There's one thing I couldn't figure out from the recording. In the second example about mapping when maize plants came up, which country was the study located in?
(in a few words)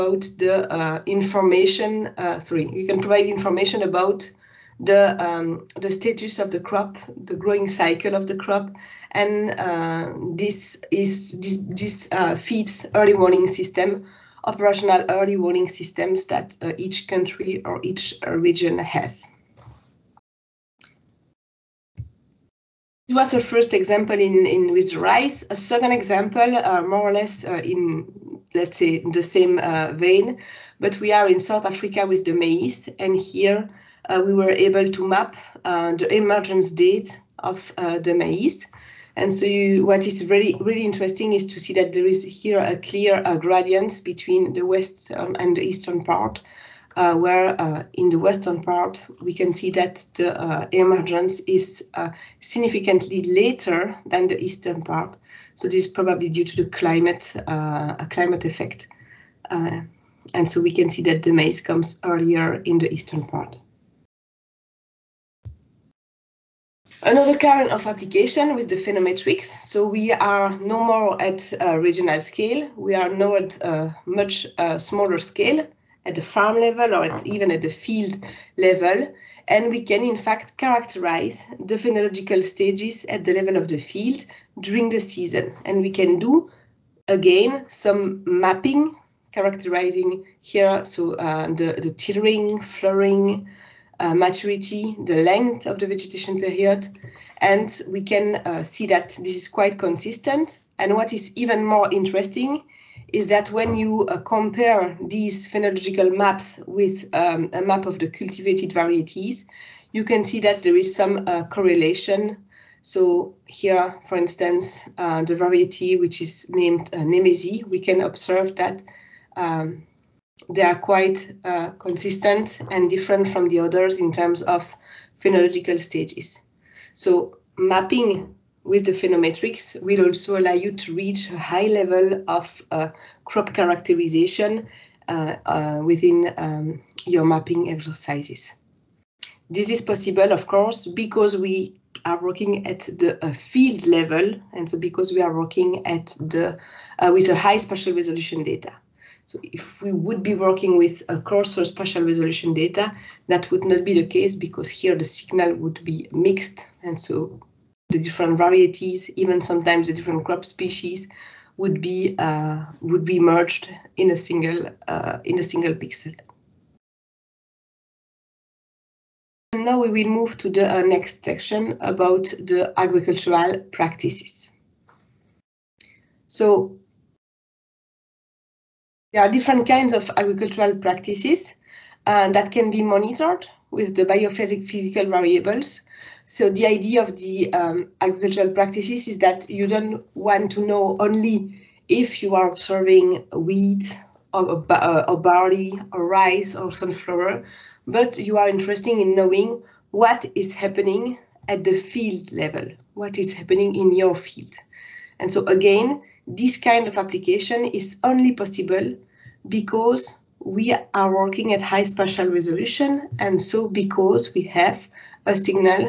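South Africa.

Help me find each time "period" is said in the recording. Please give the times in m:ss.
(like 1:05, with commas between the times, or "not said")
1:36.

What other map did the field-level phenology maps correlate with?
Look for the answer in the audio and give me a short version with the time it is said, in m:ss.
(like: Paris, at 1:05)
Cultivated varieties, at 1:48.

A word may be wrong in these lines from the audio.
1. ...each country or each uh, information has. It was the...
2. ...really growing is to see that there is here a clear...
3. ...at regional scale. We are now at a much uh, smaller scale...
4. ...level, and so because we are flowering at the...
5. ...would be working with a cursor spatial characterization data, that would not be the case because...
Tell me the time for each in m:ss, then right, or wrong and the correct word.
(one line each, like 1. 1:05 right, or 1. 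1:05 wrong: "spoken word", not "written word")
1. 0:16 wrong: "region", not "information"
2. 0:40 wrong: "interesting", not "growing"
3. 1:11 right
4. 2:23 wrong: "working", not "flowering"
5. 2:29 wrong: "resolution", not "characterization".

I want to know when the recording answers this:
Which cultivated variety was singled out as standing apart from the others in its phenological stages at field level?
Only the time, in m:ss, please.
1:57.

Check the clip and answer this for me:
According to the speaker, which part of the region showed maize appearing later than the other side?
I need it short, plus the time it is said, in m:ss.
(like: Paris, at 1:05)
Western part, at 0:48.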